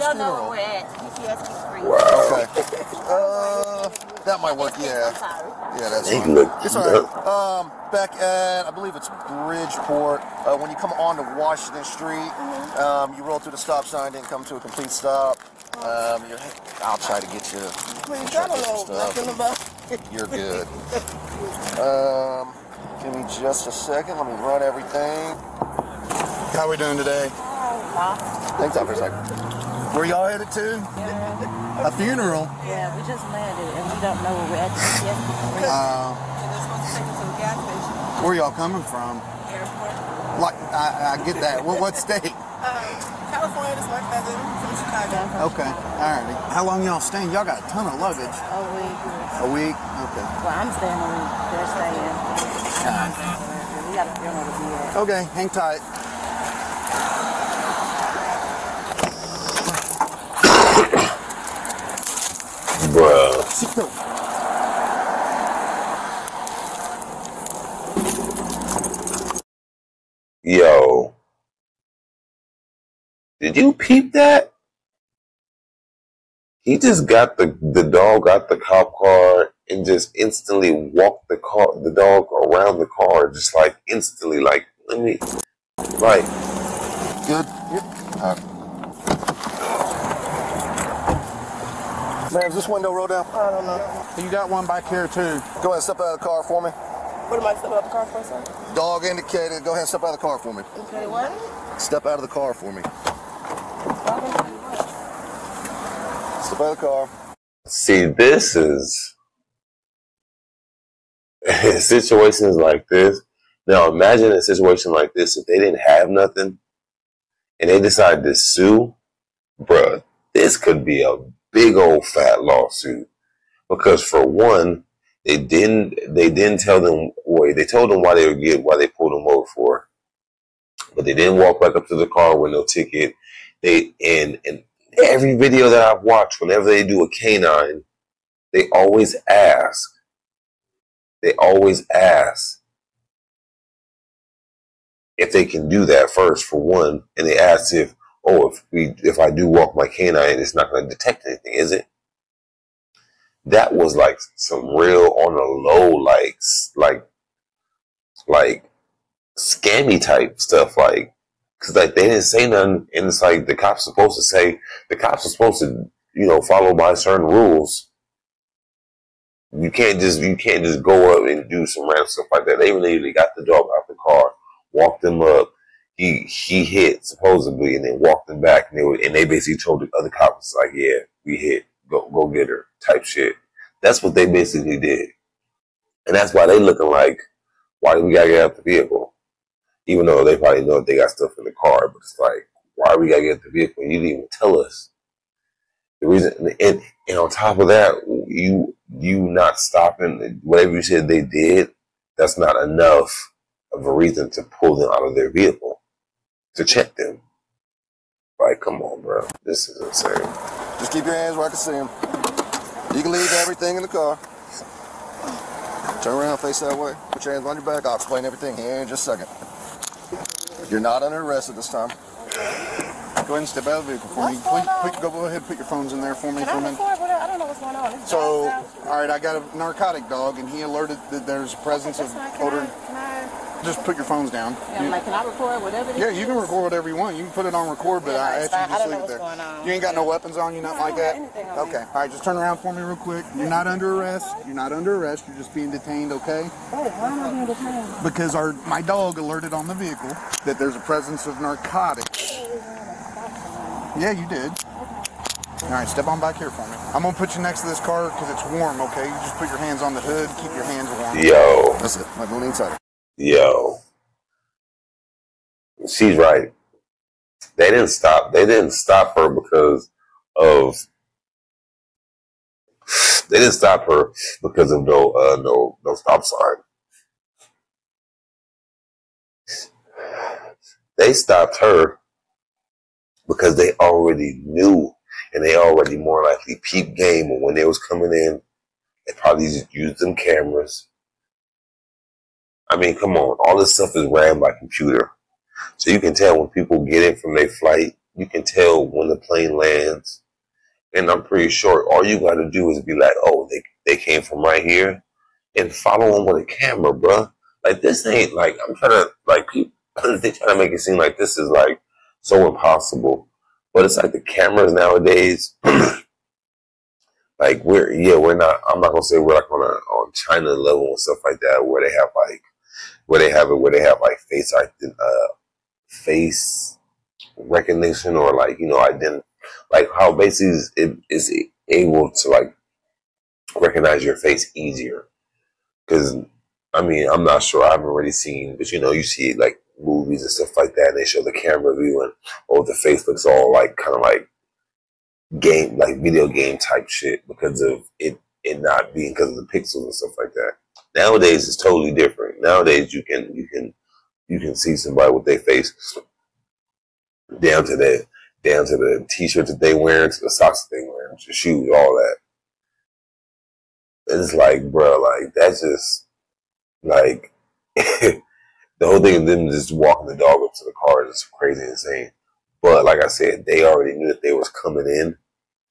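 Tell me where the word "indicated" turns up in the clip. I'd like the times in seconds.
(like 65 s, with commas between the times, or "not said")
99 s.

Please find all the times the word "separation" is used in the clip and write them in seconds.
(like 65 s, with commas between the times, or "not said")
not said.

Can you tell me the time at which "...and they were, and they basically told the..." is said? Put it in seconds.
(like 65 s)
178 s.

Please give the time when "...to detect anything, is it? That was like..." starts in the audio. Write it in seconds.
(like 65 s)
150 s.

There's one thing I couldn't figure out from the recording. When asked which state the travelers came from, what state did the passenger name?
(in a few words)
California.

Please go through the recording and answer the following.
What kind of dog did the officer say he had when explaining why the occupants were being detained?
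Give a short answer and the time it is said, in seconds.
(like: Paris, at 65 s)
Narcotic dog, at 229 s.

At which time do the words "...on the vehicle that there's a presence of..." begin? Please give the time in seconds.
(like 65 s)
249 s.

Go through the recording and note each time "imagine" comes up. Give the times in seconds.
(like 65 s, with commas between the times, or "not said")
113 s.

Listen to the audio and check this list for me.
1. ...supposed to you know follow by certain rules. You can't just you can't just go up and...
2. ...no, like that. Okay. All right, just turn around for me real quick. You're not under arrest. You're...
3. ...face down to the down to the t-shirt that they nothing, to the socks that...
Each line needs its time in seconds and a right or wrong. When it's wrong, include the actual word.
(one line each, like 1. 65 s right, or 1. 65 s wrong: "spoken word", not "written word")
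1. 165 s right
2. 240 s right
3. 355 s wrong: "wearing", not "nothing".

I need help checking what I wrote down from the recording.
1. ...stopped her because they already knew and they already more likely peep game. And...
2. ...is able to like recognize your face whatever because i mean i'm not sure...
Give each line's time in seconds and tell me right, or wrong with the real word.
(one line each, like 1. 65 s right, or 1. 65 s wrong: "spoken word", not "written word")
1. 281 s right
2. 331 s wrong: "easier", not "whatever".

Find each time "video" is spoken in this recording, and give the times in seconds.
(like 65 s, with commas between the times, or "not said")
135 s, 346 s.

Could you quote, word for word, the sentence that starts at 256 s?
I'm gonna put you next to this car because it's warm, okay?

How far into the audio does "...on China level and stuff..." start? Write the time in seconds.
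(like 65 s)
319 s.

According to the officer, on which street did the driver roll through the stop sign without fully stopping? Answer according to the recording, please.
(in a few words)
Washington Street.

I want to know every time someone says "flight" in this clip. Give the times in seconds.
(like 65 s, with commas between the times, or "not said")
297 s.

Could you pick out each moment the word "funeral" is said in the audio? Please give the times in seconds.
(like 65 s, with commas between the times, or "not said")
0 s, 31 s, 54 s.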